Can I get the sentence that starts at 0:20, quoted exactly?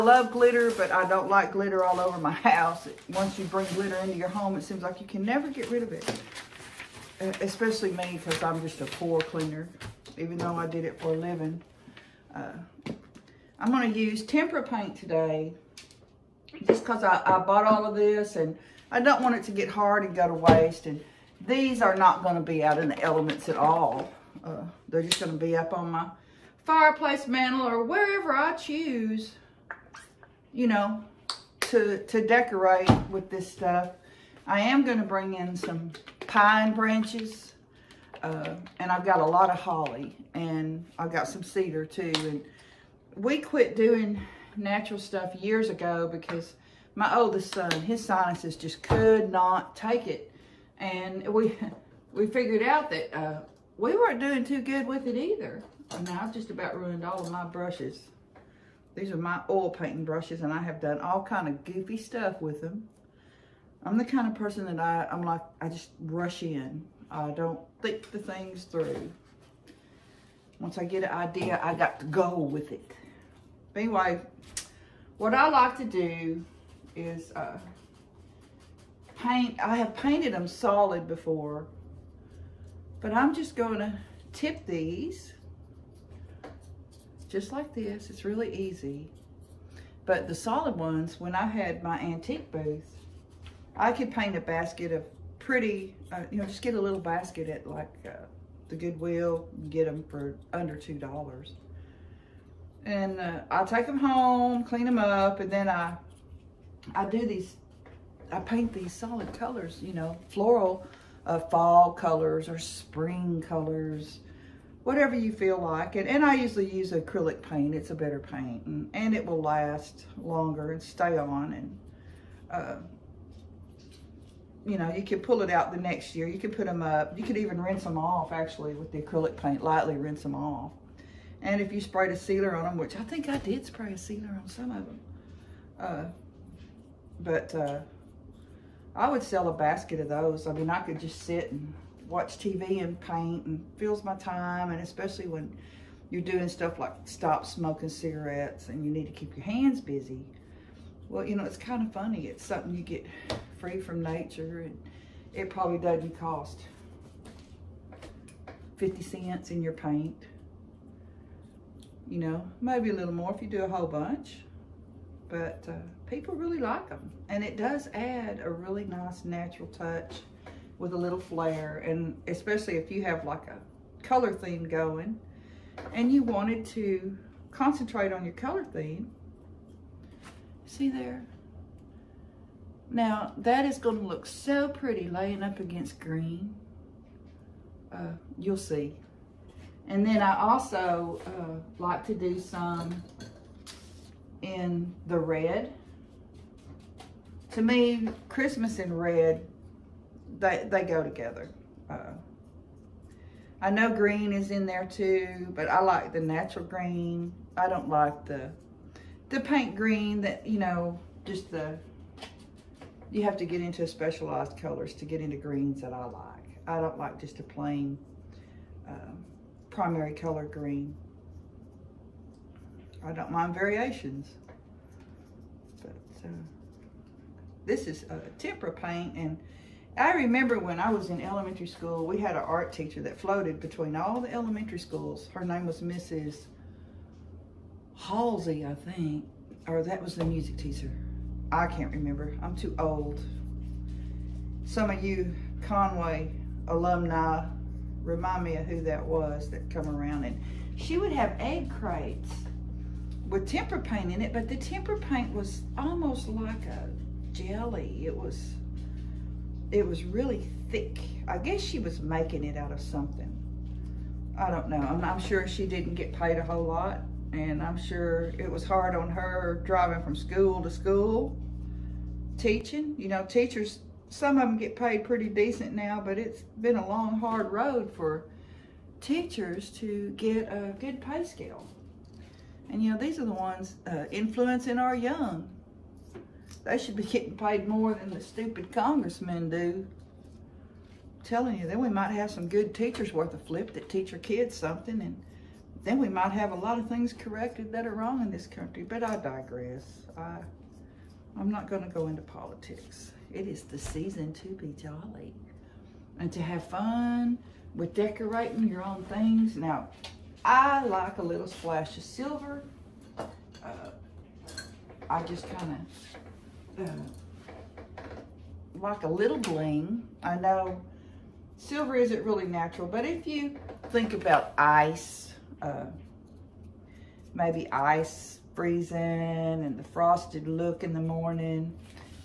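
And these are not going to be out in the elements at all.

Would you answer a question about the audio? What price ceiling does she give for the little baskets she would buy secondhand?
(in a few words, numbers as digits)
$2.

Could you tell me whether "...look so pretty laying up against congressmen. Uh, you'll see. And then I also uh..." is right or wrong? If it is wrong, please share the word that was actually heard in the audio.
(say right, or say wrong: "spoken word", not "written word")
wrong: "green", not "congressmen".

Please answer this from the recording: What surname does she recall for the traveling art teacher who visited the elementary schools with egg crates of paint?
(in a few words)
Halsey.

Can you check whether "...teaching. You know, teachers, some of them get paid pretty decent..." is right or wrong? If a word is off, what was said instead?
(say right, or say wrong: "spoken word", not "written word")
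right.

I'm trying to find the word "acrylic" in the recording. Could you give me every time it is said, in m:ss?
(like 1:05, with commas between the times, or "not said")
1:56, 2:09.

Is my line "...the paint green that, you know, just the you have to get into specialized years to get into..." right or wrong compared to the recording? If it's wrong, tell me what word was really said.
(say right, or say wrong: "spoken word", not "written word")
wrong: "colors", not "years".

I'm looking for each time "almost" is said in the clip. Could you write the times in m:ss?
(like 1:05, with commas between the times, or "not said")
4:15.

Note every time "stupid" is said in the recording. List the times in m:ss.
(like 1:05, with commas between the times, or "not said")
4:48.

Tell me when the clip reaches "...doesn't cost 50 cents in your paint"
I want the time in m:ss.
2:35.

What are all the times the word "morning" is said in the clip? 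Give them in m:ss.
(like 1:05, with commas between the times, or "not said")
5:30.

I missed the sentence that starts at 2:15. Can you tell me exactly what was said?
Uh, but uh, I would sell a basket of those.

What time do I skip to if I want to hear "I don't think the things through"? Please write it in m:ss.
1:07.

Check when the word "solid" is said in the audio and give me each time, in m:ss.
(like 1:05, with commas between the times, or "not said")
1:20, 1:30, 1:48.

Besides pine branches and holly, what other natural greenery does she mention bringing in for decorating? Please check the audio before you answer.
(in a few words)
cedar.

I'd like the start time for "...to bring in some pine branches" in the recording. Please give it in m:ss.
0:34.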